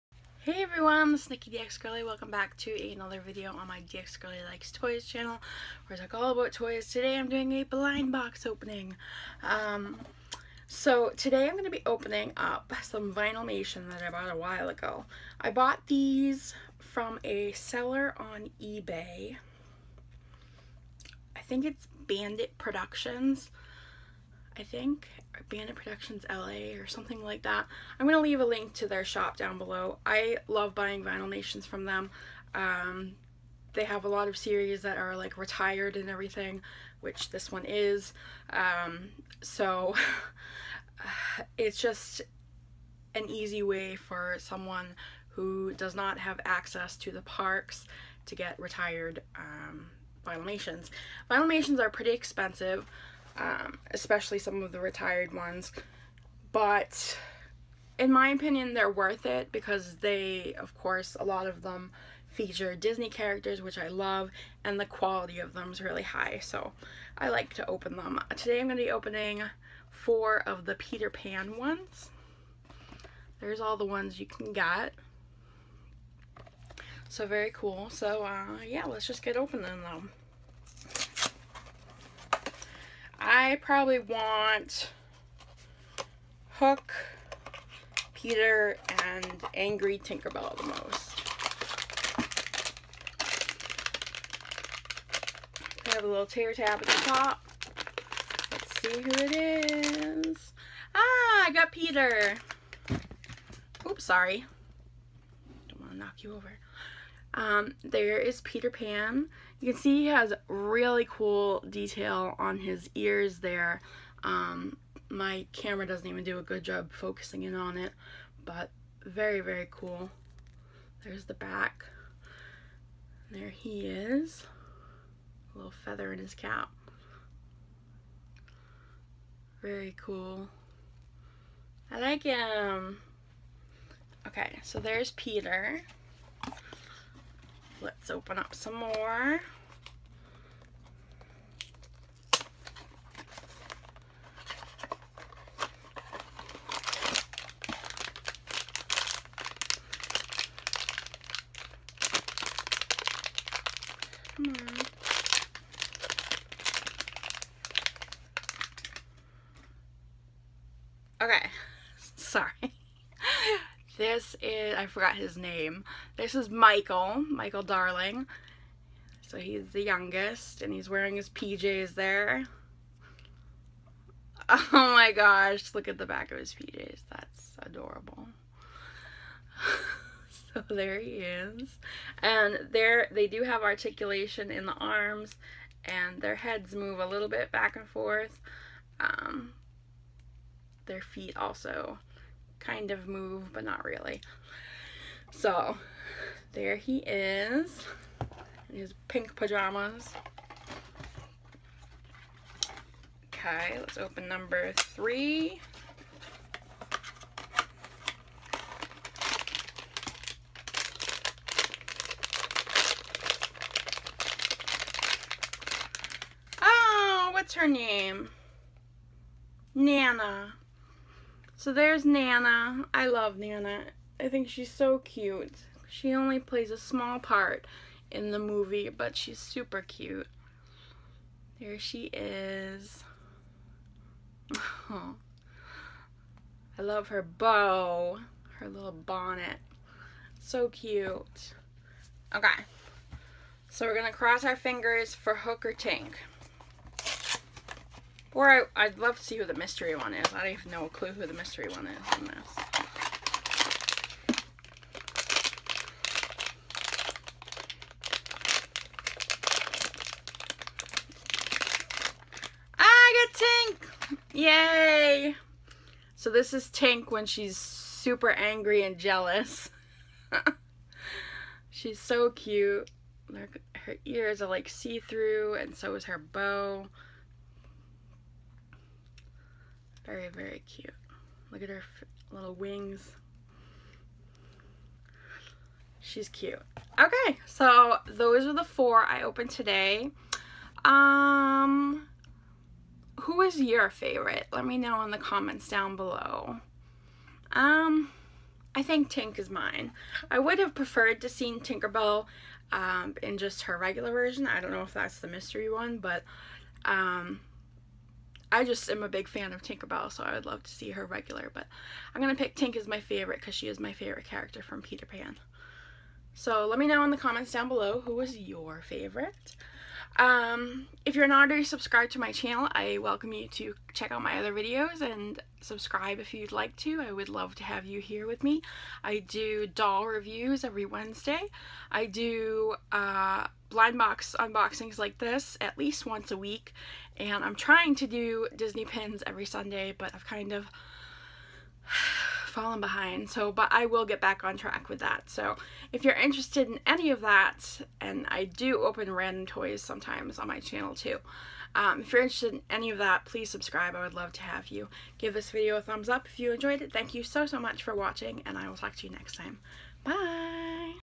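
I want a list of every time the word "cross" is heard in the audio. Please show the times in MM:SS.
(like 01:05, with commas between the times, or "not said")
04:04.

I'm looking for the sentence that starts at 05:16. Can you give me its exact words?
So let me know in the comments down below who was your favorite.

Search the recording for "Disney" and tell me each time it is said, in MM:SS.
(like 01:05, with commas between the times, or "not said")
01:02, 05:38.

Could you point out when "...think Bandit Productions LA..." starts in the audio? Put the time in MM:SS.
00:24.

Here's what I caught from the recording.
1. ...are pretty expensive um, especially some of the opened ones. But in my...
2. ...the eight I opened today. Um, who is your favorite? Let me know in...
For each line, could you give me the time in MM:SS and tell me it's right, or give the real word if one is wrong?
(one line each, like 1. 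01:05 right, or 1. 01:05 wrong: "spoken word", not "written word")
1. 00:51 wrong: "retired", not "opened"
2. 04:48 wrong: "four", not "eight".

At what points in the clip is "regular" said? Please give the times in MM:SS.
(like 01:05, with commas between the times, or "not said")
05:03, 05:11.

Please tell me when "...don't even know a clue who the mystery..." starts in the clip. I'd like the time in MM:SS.
04:10.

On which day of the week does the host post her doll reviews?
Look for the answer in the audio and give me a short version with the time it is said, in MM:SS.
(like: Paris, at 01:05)
Wednesday, at 05:30.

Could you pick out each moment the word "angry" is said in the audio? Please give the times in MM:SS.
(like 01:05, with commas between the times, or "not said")
01:29, 04:28.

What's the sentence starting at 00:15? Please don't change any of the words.
I bought these from a seller on eBay.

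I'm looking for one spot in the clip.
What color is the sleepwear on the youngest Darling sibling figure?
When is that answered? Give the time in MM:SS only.
03:19.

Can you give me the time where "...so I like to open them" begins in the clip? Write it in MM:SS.
01:06.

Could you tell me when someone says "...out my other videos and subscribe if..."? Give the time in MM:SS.
05:24.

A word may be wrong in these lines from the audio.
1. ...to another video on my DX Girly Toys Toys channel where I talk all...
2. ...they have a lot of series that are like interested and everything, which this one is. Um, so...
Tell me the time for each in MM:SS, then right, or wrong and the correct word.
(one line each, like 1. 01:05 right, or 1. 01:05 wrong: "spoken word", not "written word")
1. 00:02 wrong: "Likes", not "Toys"
2. 00:33 wrong: "retired", not "interested".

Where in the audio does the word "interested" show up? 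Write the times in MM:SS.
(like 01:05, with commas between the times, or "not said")
05:46, 05:52.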